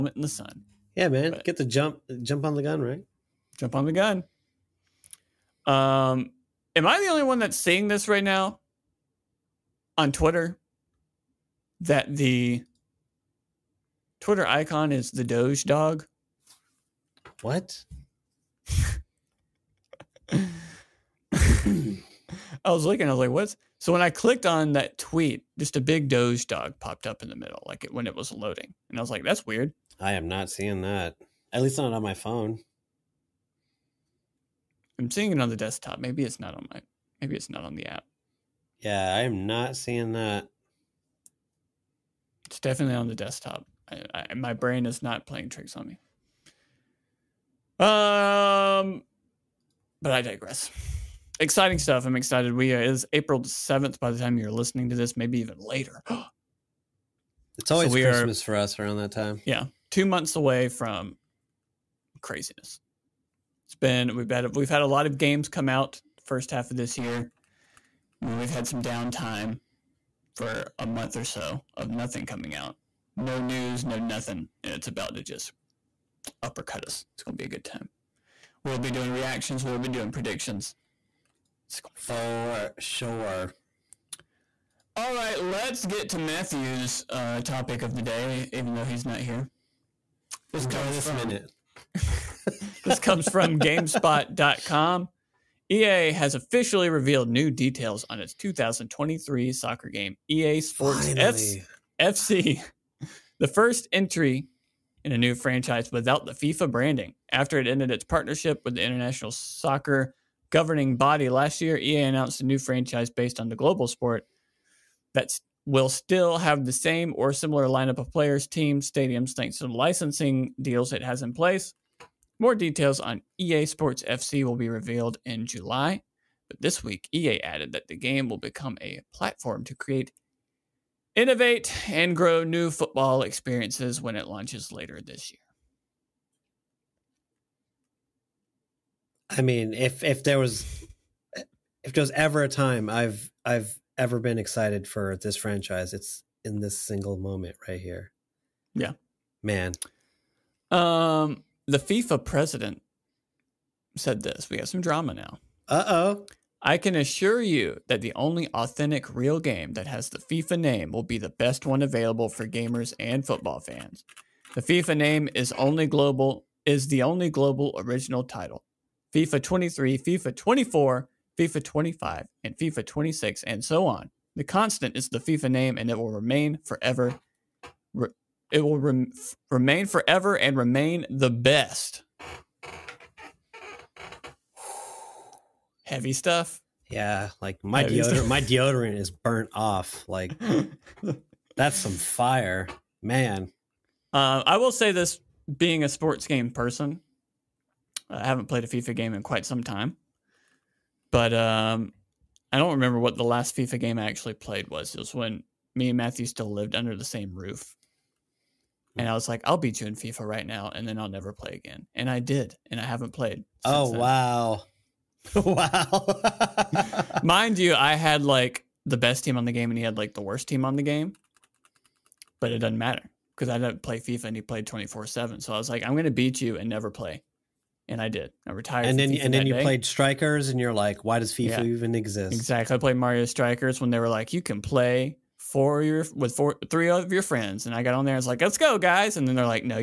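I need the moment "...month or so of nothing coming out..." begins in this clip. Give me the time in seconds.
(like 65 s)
70 s.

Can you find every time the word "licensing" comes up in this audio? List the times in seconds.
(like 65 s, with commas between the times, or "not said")
119 s.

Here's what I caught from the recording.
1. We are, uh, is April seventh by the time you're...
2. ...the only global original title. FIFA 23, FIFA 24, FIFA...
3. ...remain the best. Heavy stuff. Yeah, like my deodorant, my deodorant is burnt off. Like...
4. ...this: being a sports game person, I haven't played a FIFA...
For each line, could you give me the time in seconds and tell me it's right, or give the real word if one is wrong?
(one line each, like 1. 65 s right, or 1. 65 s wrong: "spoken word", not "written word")
1. 52 s right
2. 166 s right
3. 180 s right
4. 194 s right.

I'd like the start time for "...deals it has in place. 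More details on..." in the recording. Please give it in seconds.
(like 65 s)
120 s.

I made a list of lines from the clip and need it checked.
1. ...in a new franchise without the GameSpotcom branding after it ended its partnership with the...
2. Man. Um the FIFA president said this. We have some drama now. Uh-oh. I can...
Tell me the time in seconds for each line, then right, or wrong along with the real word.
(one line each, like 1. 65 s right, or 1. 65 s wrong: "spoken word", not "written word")
1. 105 s wrong: "FIFA", not "GameSpotcom"
2. 149 s right.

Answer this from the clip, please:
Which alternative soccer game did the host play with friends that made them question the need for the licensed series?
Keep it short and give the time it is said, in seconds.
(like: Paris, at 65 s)
Mario Strikers, at 232 s.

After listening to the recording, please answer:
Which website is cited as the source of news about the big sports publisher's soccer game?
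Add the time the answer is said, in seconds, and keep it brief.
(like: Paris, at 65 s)
GameSpot.com, at 93 s.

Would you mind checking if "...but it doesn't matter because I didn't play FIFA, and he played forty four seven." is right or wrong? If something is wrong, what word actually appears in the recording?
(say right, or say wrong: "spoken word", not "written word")
wrong: "twenty", not "forty".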